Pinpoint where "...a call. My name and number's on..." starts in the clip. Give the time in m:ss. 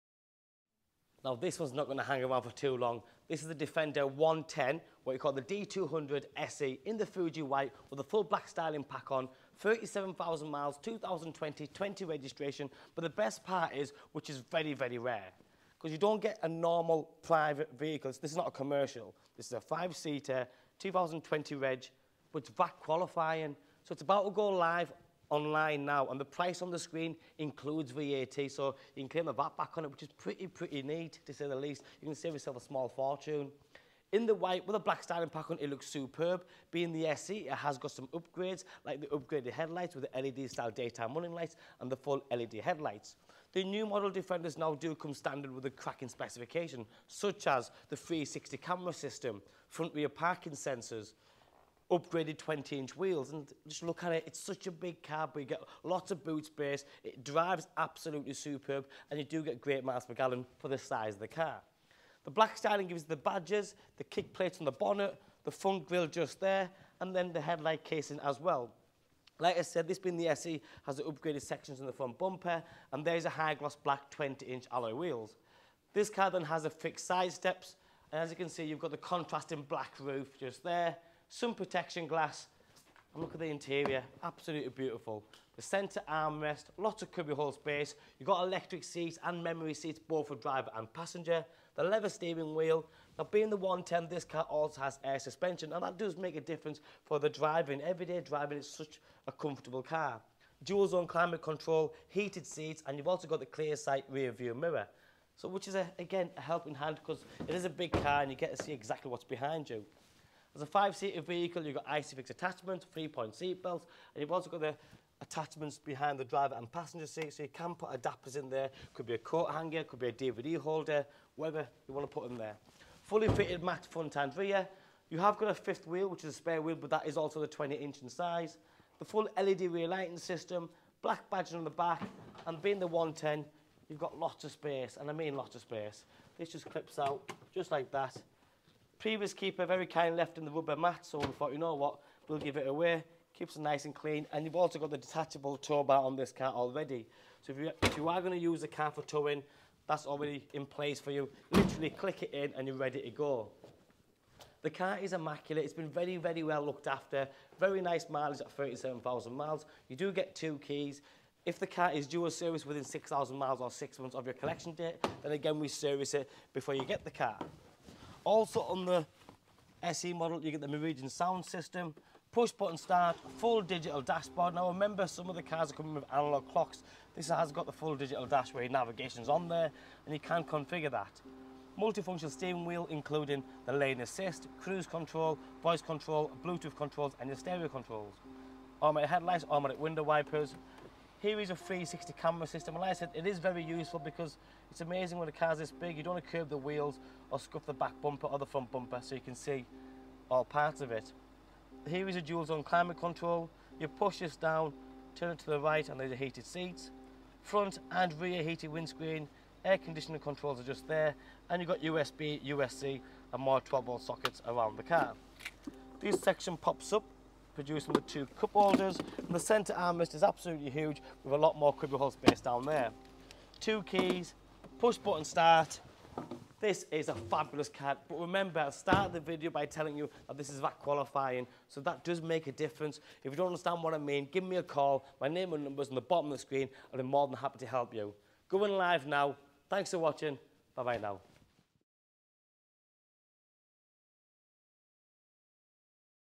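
3:54.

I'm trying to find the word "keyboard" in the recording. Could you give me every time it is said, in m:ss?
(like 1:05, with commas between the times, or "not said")
not said.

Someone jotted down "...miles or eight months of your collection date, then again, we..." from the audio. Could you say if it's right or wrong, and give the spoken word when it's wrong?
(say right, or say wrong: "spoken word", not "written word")
wrong: "six", not "eight".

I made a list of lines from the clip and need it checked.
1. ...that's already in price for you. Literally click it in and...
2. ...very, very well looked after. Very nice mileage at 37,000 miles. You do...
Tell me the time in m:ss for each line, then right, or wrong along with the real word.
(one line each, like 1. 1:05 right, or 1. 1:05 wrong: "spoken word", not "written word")
1. 2:29 wrong: "place", not "price"
2. 2:35 right.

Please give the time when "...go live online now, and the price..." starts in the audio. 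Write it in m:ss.
0:24.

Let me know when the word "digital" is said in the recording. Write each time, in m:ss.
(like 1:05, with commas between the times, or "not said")
2:53, 2:57.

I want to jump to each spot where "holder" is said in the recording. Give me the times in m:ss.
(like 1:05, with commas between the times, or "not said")
2:00, 3:38.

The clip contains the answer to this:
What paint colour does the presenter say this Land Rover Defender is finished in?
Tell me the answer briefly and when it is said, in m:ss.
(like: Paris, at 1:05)
Fuji white, at 0:07.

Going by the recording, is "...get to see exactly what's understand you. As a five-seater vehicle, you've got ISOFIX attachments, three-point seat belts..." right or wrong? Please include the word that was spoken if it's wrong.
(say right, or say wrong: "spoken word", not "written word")
wrong: "behind", not "understand".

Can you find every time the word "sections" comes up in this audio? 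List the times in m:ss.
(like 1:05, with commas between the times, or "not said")
1:11, 3:36.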